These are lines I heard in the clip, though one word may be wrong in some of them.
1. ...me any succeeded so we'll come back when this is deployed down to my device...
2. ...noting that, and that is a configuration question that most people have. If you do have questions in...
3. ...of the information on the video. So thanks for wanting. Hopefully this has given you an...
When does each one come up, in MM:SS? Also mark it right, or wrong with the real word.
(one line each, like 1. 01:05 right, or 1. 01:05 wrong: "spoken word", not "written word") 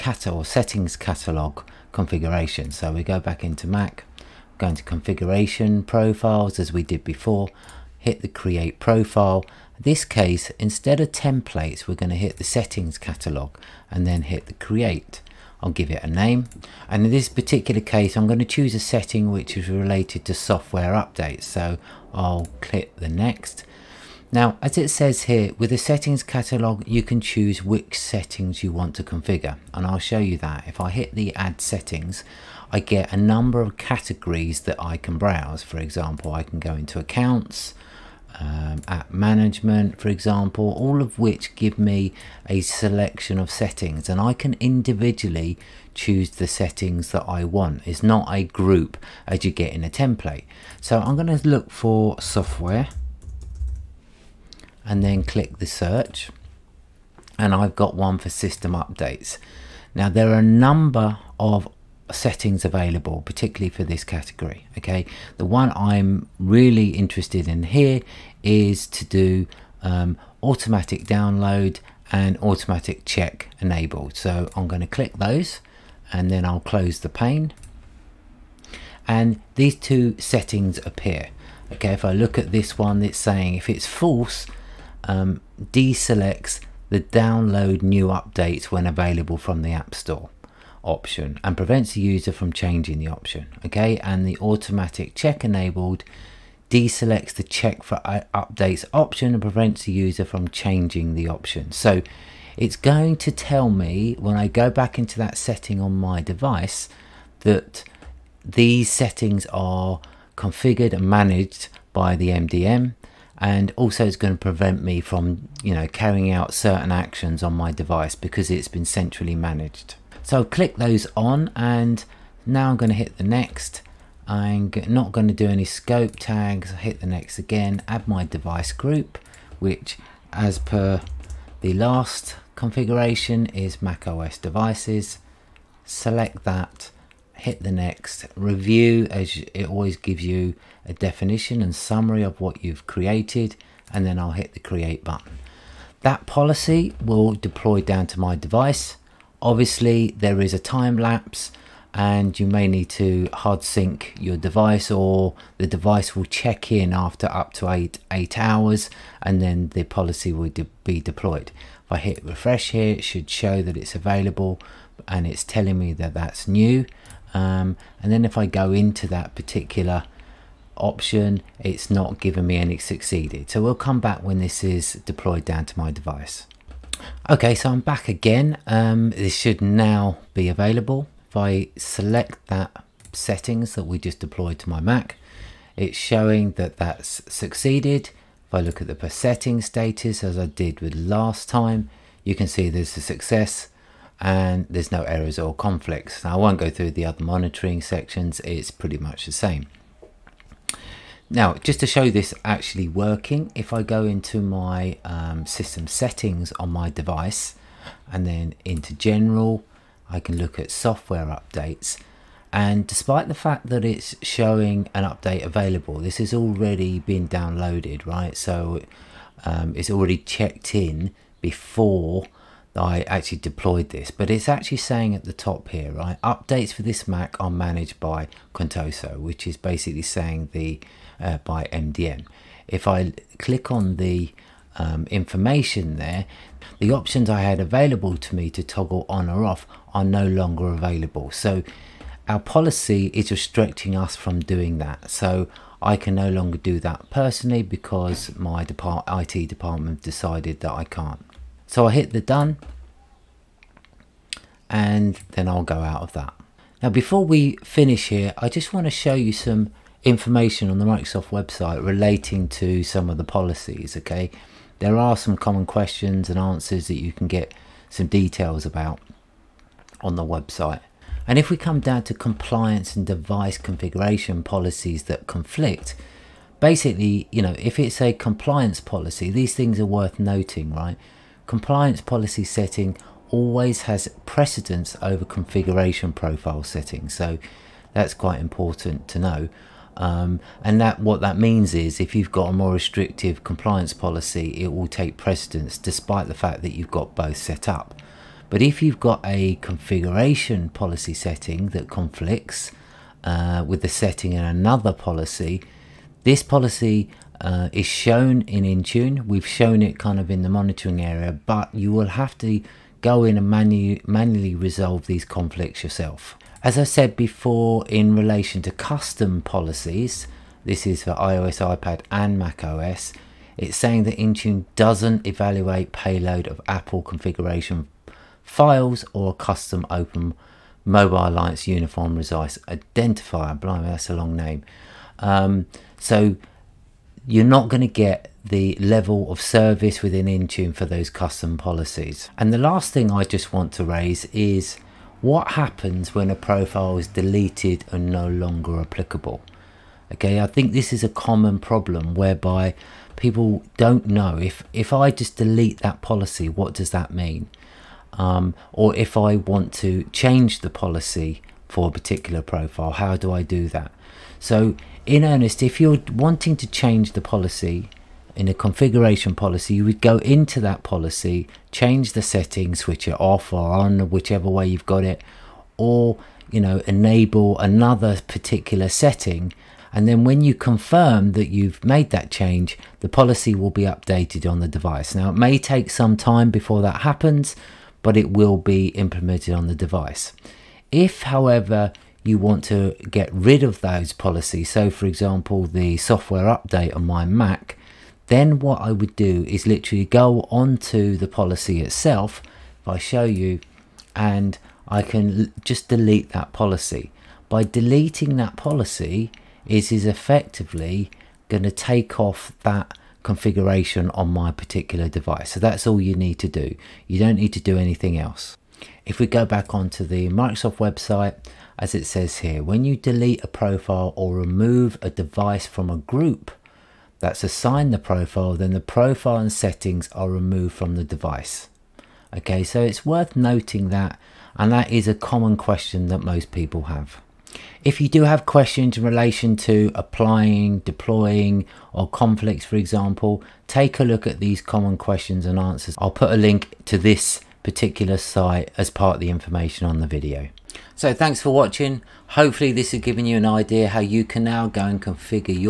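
1. 02:52 right
2. 07:13 wrong: "common", not "configuration"
3. 07:29 wrong: "watching", not "wanting".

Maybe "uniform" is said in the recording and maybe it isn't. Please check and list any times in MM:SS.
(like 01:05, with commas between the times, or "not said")
05:31.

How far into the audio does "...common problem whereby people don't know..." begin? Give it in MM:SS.
05:51.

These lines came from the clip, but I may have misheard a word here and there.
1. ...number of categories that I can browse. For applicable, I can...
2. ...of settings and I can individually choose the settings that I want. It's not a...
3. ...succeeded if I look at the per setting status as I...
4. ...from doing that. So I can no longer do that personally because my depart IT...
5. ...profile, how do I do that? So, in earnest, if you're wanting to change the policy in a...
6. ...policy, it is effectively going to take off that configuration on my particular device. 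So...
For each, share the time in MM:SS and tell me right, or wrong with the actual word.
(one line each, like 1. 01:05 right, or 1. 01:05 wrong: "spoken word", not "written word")
1. 00:33 wrong: "example", not "applicable"
2. 00:43 right
3. 03:07 right
4. 04:04 right
5. 06:02 right
6. 06:48 right.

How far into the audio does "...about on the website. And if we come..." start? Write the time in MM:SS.
04:28.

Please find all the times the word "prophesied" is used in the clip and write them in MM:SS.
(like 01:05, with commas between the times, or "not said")
not said.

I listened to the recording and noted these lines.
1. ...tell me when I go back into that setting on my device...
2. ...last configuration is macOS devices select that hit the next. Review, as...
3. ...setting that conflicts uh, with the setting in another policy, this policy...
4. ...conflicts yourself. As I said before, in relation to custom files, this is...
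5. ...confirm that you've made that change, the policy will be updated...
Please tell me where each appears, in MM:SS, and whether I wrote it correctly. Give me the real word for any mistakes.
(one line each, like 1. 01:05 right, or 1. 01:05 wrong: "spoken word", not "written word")
1. 01:43 right
2. 02:11 right
3. 05:01 right
4. 05:15 wrong: "policies", not "files"
5. 06:20 right.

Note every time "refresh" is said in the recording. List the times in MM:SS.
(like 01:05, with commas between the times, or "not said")
02:42.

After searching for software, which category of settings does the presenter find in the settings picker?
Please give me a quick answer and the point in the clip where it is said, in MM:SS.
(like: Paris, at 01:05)
System updates, at 00:58.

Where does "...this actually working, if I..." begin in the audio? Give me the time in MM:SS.
03:22.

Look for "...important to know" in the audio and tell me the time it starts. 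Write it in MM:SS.
04:48.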